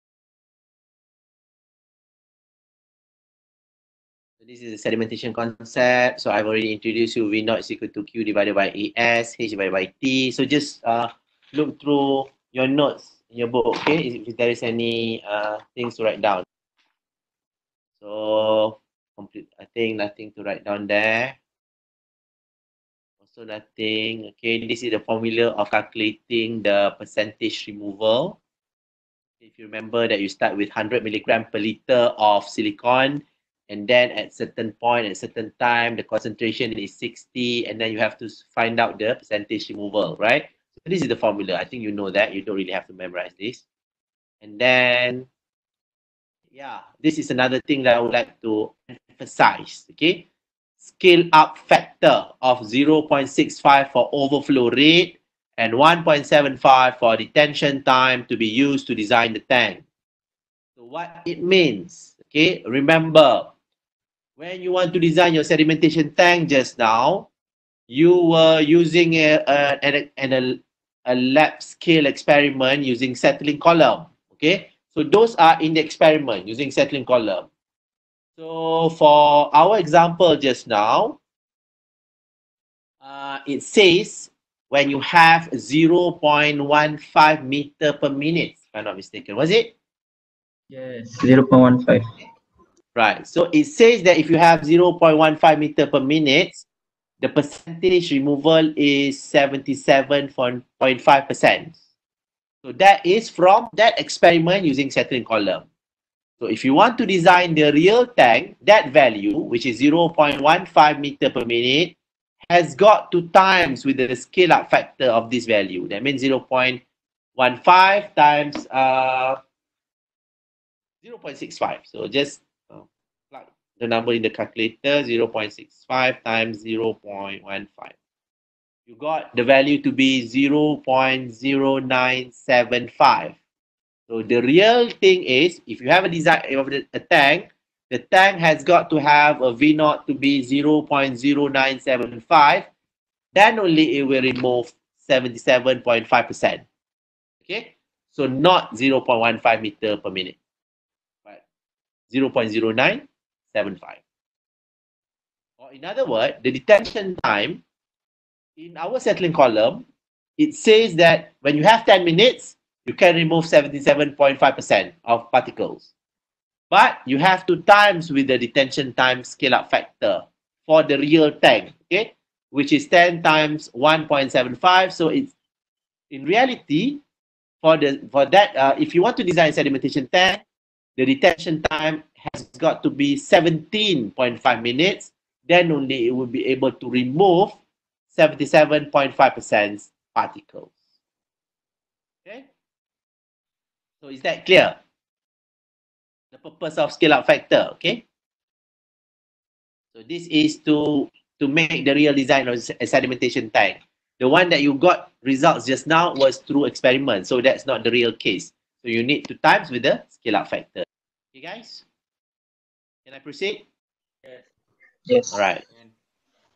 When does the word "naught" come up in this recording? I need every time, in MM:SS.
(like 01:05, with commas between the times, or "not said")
00:07, 02:19.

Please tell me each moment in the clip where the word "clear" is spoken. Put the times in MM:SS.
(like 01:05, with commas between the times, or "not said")
03:14.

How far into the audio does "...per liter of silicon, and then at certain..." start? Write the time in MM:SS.
00:31.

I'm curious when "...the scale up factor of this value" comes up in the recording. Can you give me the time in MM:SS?
01:53.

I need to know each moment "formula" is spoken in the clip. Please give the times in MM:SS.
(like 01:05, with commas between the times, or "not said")
00:25, 00:41.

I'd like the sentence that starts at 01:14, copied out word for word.
Okay, so those are in the experiment using settling column.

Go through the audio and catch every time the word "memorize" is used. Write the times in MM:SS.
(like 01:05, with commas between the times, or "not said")
00:42.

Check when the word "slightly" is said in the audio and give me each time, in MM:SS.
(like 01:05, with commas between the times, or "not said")
not said.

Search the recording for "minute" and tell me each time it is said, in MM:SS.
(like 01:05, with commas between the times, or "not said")
01:28, 01:36, 01:51, 02:30, 02:42, 03:04.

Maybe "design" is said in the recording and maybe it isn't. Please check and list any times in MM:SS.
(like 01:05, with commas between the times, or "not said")
00:58, 01:04, 01:47, 02:16, 02:59, 03:22.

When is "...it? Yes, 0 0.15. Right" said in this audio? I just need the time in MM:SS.
01:29.